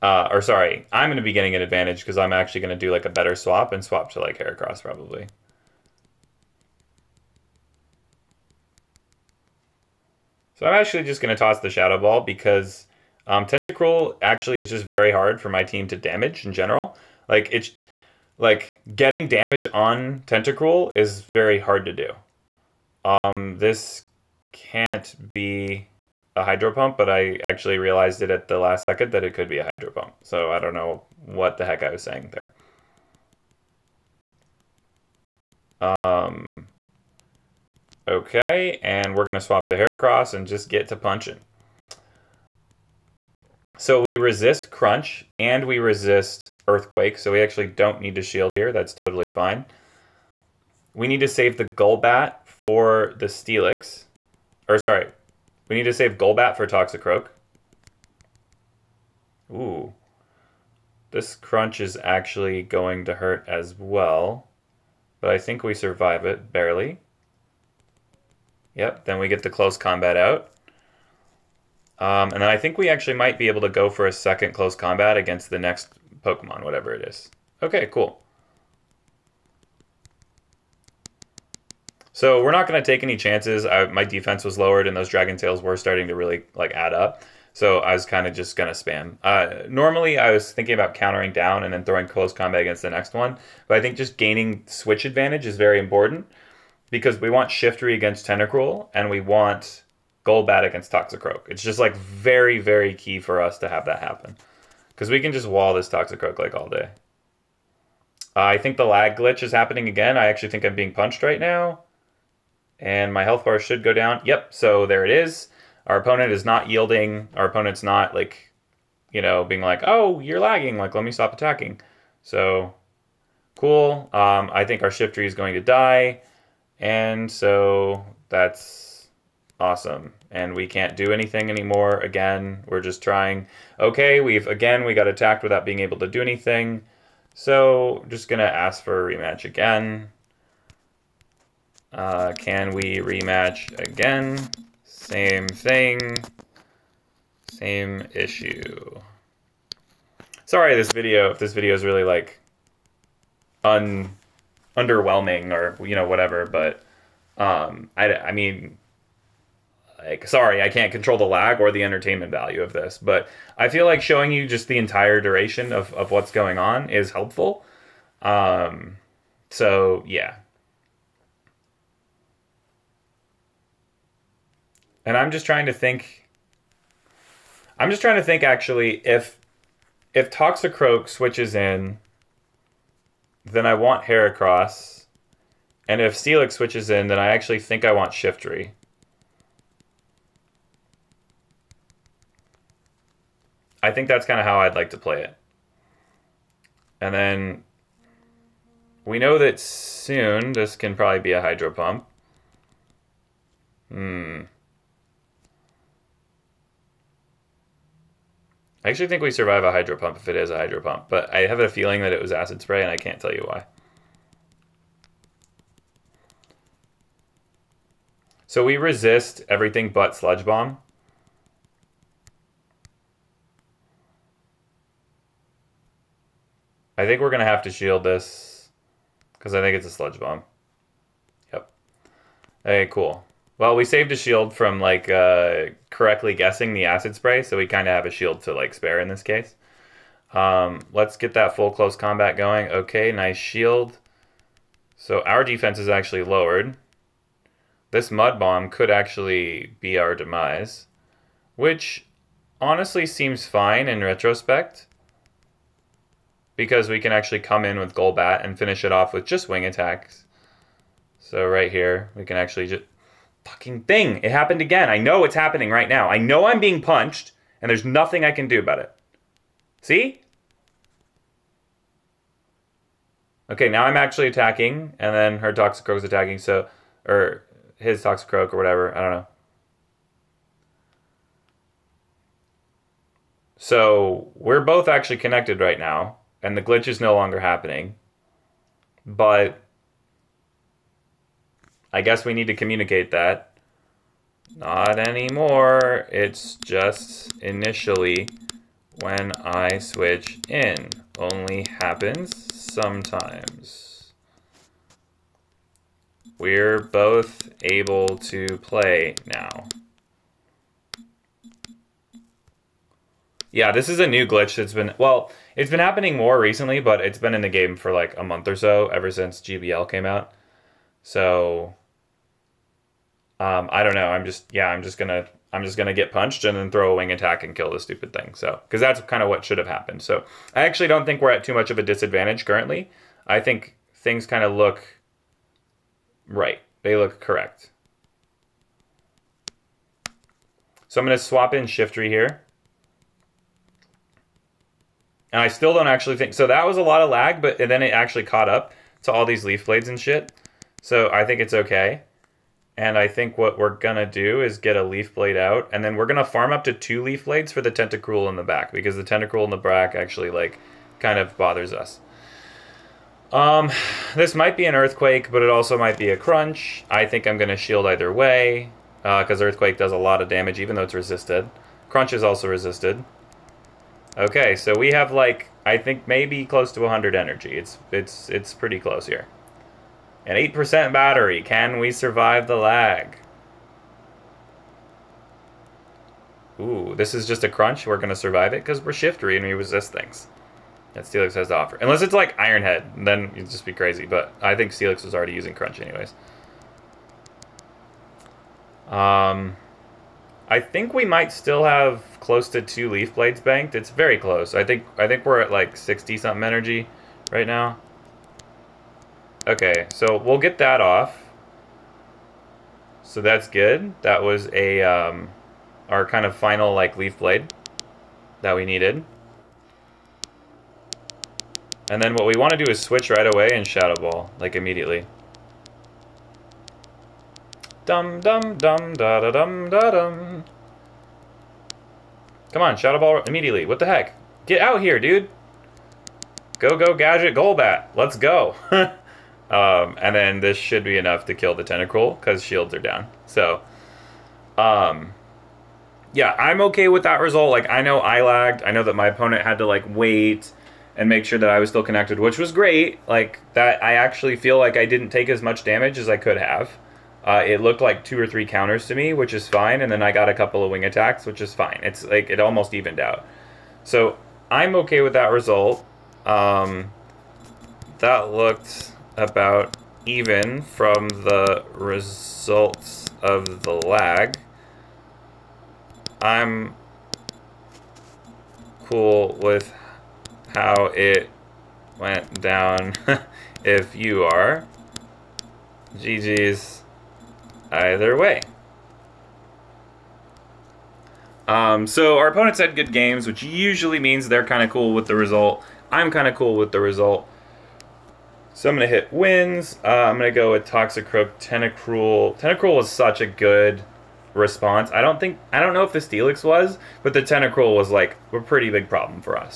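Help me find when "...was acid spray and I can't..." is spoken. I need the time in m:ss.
3:32.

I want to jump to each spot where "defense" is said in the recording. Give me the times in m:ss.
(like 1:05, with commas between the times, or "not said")
1:24, 4:05.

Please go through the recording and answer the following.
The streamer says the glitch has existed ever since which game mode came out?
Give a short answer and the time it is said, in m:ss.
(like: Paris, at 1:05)
GBL, at 5:19.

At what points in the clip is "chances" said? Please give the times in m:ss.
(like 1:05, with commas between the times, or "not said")
1:23.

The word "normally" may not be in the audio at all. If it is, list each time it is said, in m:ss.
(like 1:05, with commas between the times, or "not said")
1:29.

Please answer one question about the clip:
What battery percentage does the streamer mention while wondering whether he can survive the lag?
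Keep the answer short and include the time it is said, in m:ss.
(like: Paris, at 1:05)
8%, at 6:20.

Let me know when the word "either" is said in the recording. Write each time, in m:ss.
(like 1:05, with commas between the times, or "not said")
6:07, 8:07.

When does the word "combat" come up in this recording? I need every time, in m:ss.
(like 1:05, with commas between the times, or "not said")
1:09, 1:14, 1:32, 4:01.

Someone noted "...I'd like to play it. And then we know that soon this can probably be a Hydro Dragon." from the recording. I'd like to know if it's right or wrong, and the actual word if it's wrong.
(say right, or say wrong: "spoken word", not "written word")
wrong: "Pump", not "Dragon".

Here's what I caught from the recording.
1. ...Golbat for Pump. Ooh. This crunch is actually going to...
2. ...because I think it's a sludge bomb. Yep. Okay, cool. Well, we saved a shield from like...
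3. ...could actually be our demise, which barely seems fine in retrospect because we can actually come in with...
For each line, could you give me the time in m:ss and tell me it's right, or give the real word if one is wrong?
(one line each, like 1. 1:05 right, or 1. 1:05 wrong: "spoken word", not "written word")
1. 0:56 wrong: "Toxicroak", not "Pump"
2. 3:49 right
3. 4:08 wrong: "honestly", not "barely".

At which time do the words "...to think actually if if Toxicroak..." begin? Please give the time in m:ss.
2:58.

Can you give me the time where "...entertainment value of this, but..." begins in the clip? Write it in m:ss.
2:41.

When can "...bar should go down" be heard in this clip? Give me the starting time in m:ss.
1:53.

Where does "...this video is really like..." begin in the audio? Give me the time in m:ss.
2:31.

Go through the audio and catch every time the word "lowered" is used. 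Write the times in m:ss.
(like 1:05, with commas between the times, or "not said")
1:24, 4:06.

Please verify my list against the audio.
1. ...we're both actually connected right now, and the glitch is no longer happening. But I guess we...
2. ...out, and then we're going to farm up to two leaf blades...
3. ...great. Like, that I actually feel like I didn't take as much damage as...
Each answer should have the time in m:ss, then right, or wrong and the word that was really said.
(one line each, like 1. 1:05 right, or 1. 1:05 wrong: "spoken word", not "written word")
1. 4:44 right
2. 5:55 right
3. 7:32 right.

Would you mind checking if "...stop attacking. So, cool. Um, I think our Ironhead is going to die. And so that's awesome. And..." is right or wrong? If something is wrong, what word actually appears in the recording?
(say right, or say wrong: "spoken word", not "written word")
wrong: "Shiftry", not "Ironhead".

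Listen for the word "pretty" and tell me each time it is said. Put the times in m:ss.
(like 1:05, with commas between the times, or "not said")
6:18, 8:28.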